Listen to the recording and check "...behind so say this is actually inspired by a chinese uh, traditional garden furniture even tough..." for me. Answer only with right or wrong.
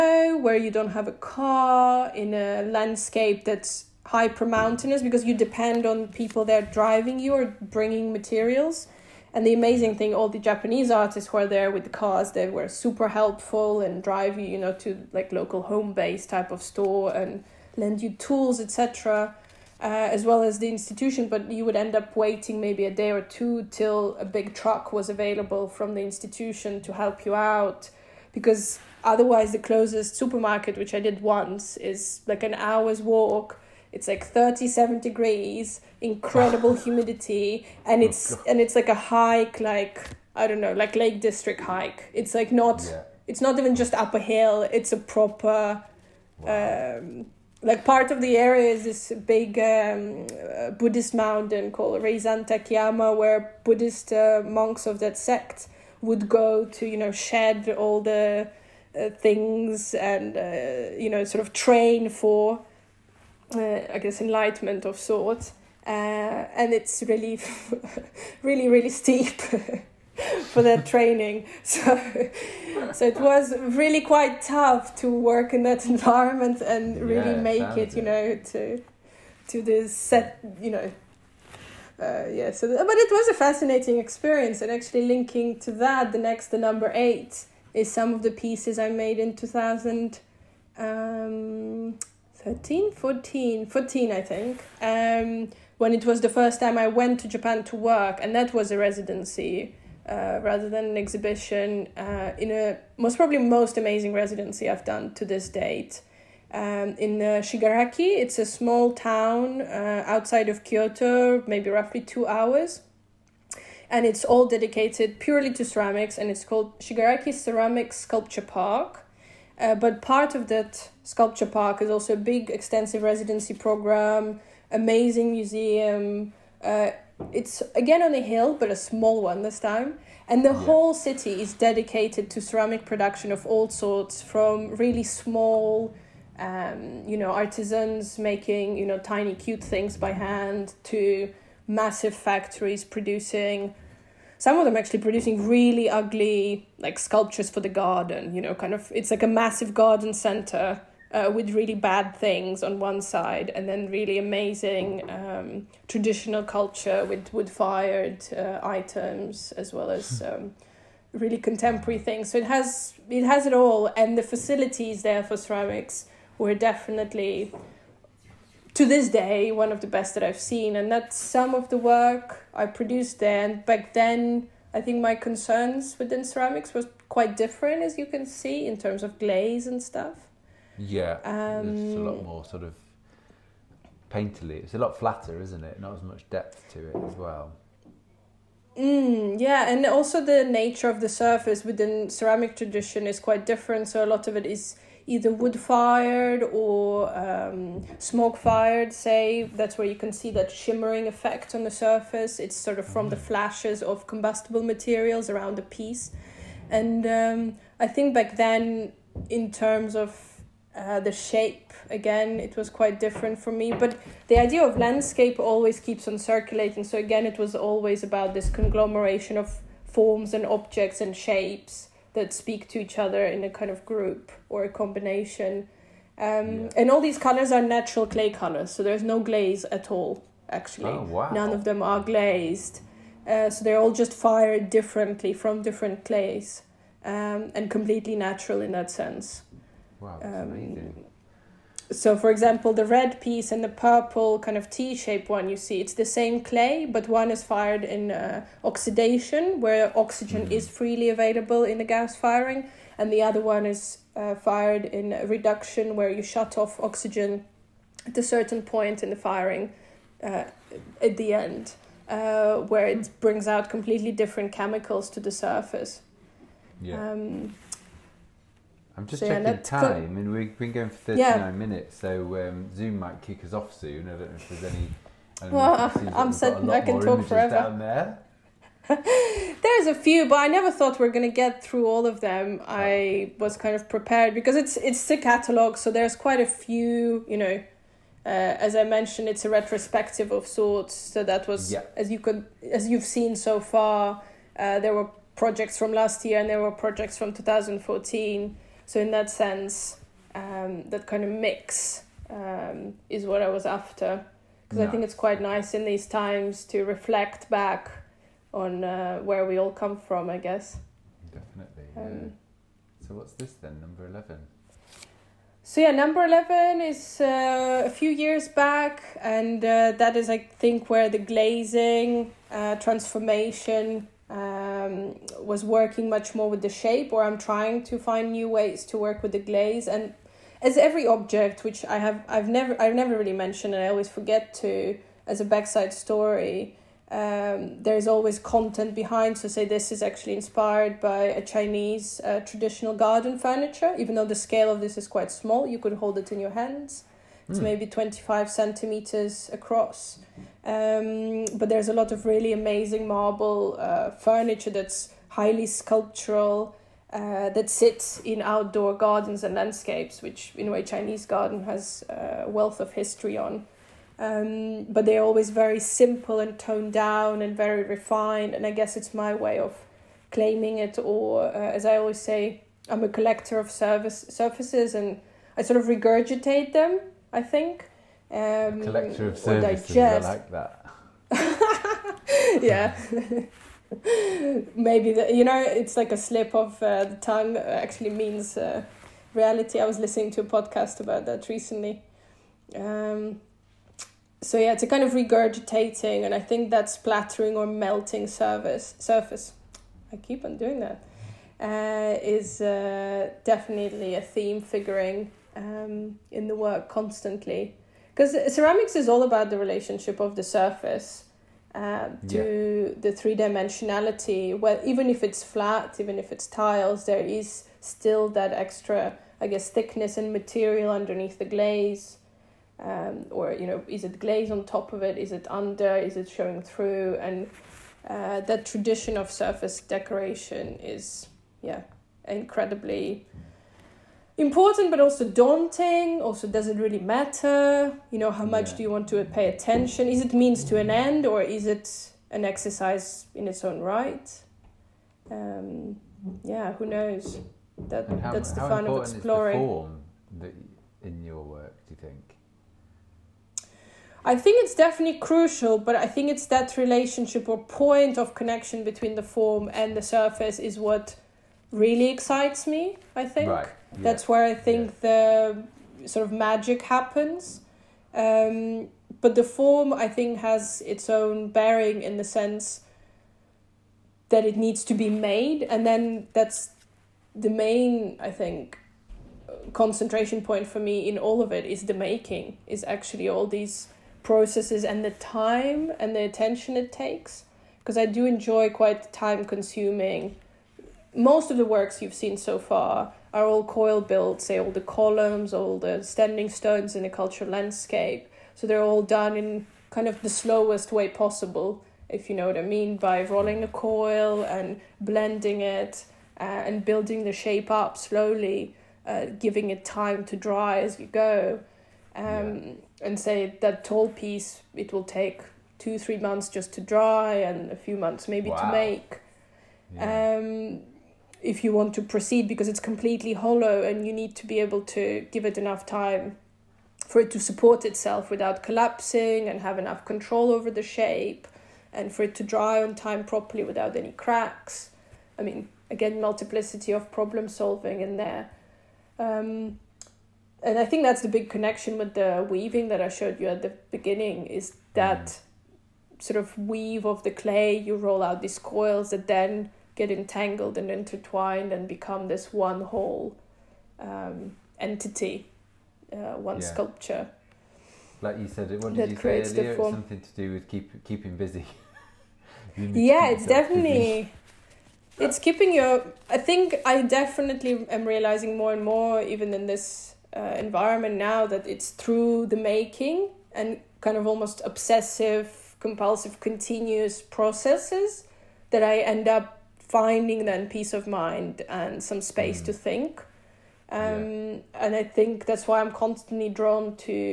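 wrong.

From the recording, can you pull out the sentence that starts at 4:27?
Um, I'm just so checking yeah, time, and we've been going for 39 yeah.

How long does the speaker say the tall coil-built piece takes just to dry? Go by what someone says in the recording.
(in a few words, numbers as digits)
two, three months.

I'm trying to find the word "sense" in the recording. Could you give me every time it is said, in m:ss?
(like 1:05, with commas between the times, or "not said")
3:58, 4:59, 7:52.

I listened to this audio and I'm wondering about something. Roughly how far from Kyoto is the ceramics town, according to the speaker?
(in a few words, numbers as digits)
two hours.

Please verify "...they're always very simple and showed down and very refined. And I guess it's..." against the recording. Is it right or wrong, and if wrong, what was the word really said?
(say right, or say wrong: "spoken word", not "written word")
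wrong: "toned", not "showed".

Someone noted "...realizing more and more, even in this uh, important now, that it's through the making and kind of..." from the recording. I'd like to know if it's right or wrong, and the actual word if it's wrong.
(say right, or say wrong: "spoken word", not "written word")
wrong: "environment", not "important".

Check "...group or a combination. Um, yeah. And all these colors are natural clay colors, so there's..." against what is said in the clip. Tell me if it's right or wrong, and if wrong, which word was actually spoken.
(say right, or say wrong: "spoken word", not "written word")
right.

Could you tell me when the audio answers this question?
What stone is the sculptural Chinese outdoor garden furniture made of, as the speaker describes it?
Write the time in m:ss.
5:53.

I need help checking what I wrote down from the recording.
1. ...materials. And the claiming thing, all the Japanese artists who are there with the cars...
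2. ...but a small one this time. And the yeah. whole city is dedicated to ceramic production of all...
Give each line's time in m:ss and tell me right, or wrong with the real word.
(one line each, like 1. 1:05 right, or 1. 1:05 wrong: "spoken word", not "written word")
1. 0:08 wrong: "amazing", not "claiming"
2. 2:08 right.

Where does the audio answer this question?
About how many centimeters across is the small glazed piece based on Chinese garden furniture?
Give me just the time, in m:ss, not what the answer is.
5:47.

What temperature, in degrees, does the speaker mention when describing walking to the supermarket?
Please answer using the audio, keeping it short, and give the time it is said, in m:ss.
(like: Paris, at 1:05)
37, at 0:34.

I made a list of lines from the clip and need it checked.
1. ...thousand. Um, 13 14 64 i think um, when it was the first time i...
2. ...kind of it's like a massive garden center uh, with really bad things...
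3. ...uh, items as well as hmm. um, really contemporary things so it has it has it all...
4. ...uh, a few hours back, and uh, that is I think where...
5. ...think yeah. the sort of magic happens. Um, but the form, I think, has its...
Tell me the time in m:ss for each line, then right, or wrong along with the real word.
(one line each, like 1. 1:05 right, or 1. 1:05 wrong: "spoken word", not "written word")
1. 1:29 wrong: "14", not "64"
2. 2:28 right
3. 2:38 right
4. 5:17 wrong: "years", not "hours"
5. 7:44 right.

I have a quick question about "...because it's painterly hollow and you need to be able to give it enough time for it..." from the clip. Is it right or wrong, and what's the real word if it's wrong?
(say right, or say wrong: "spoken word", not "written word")
wrong: "completely", not "painterly".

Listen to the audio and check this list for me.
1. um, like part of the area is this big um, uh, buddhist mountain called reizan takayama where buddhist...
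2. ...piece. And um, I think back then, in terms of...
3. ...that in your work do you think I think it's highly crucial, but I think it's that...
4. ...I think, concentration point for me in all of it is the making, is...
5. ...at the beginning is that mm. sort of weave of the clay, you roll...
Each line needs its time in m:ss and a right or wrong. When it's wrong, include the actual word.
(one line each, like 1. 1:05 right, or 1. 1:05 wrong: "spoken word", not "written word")
1. 0:46 right
2. 3:25 right
3. 7:30 wrong: "definitely", not "highly"
4. 7:58 right
5. 9:03 right.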